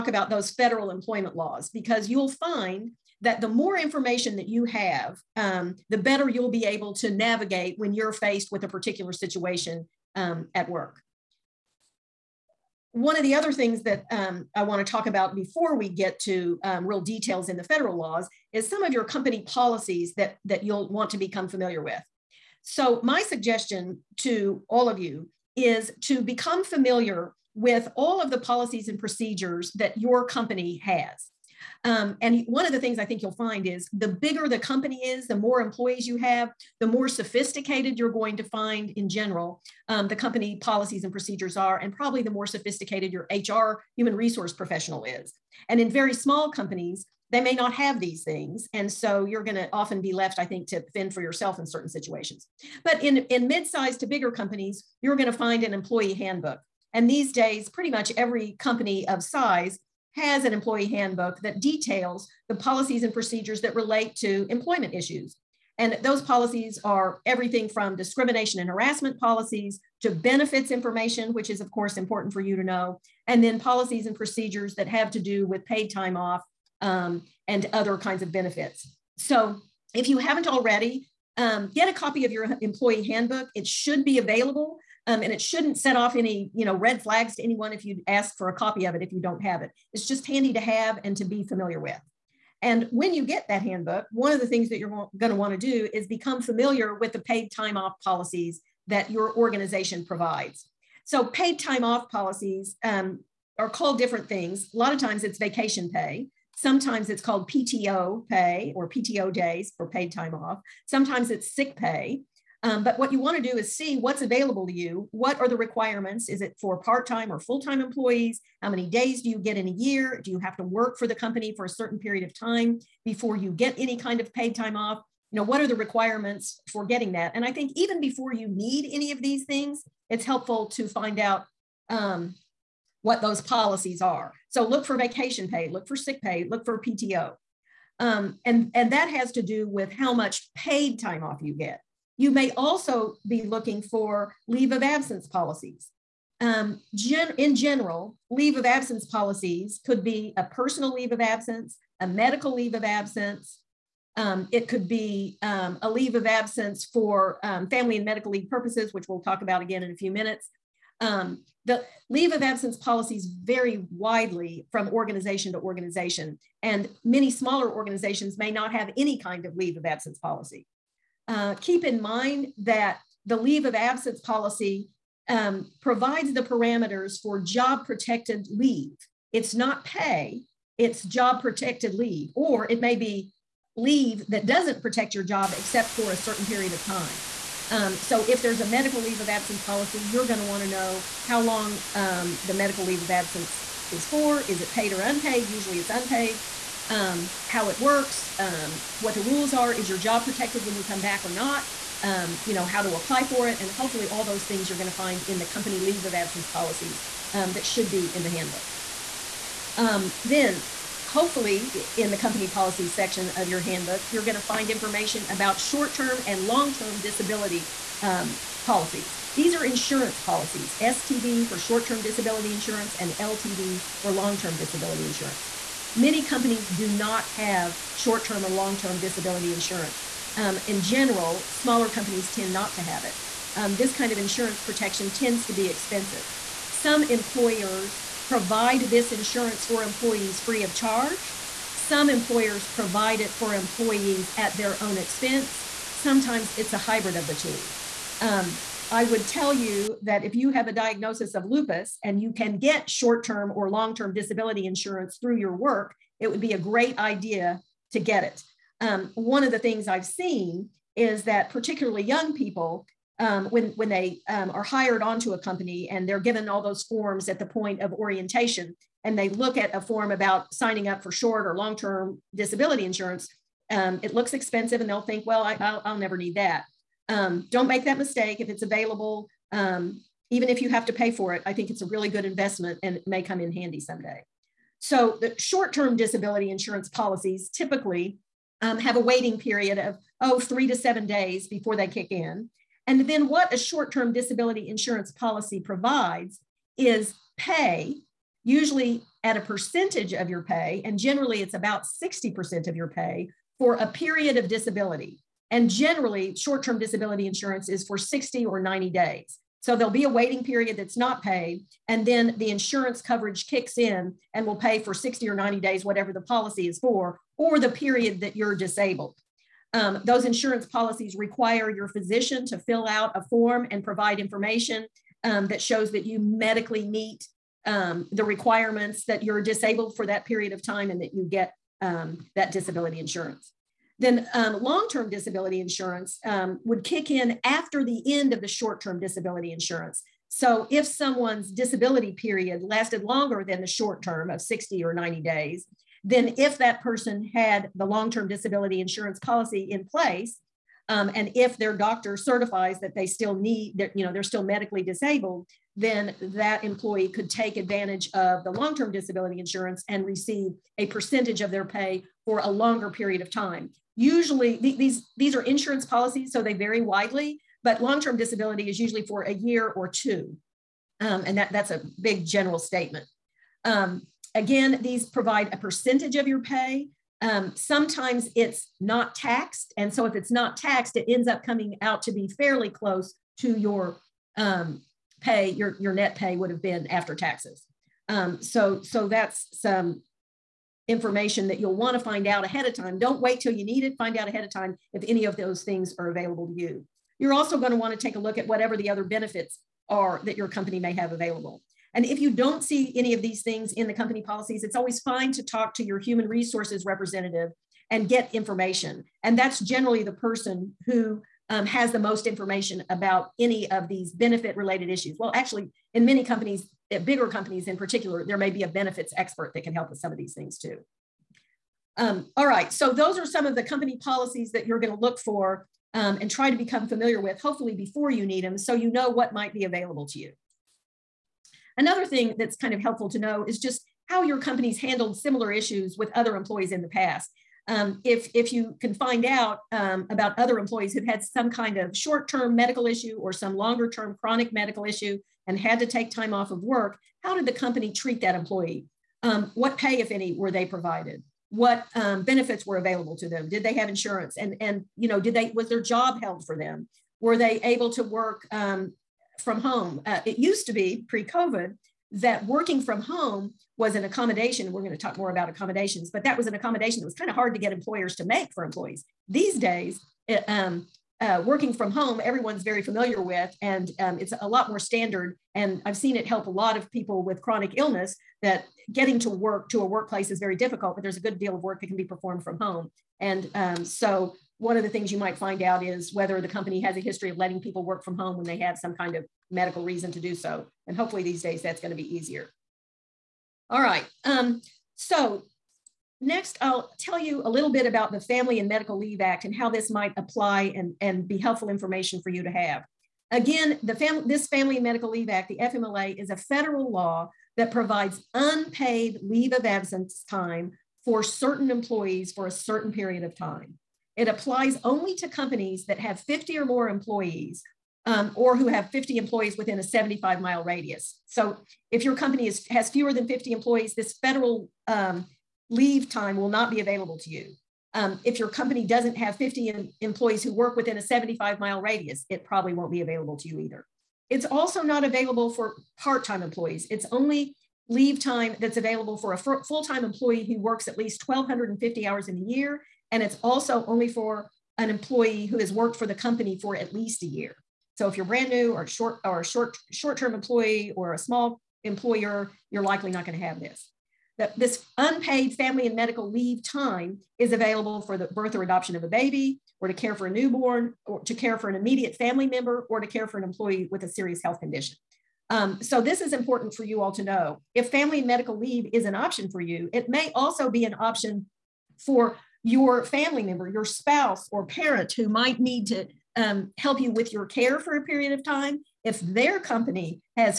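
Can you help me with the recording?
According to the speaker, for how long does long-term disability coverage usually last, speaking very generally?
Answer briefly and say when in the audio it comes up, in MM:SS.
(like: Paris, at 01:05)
A year or two, at 06:09.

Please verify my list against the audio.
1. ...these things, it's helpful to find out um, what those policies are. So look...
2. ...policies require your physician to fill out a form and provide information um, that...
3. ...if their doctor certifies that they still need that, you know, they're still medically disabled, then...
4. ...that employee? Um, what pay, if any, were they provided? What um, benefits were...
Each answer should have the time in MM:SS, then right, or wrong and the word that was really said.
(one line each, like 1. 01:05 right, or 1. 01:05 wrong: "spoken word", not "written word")
1. 02:09 right
2. 05:20 right
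3. 05:51 right
4. 07:28 right.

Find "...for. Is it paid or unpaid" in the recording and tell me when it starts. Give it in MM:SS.
03:14.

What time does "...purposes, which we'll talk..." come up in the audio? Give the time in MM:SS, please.
02:38.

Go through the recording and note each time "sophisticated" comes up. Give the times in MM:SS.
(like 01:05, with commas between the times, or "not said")
00:37, 00:42.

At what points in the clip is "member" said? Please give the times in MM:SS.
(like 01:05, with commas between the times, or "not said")
09:22, 09:33.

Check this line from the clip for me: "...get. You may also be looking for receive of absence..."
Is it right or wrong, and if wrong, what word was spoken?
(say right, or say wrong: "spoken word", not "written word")
wrong: "leave", not "receive".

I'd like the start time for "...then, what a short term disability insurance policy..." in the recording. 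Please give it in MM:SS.
04:53.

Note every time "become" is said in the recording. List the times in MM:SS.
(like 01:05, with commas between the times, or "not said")
00:21, 00:26, 01:36, 07:06.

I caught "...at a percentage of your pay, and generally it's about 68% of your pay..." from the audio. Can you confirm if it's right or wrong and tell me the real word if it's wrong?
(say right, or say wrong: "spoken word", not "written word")
wrong: "60", not "68".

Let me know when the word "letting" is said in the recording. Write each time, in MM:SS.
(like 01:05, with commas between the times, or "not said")
08:07.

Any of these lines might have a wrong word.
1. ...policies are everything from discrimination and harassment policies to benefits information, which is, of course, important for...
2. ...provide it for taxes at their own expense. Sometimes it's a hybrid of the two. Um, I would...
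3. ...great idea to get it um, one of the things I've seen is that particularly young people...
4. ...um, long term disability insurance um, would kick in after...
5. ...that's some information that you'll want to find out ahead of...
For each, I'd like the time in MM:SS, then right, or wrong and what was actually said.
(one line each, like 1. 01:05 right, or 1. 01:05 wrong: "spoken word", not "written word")
1. 01:06 right
2. 04:02 wrong: "employees", not "taxes"
3. 04:16 right
4. 05:34 right
5. 06:29 right.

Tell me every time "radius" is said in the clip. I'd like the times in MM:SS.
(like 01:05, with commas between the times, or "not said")
08:40, 08:51.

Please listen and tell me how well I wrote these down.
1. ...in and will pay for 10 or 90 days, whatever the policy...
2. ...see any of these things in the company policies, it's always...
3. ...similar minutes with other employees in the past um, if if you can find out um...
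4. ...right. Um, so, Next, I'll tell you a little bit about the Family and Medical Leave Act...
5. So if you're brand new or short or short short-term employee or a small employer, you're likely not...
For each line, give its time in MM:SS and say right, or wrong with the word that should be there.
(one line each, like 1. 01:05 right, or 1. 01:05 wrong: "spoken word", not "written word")
1. 05:13 wrong: "60", not "10"
2. 06:42 right
3. 07:15 wrong: "issues", not "minutes"
4. 08:13 right
5. 09:07 right.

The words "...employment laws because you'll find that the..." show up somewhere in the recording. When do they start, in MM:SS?
00:00.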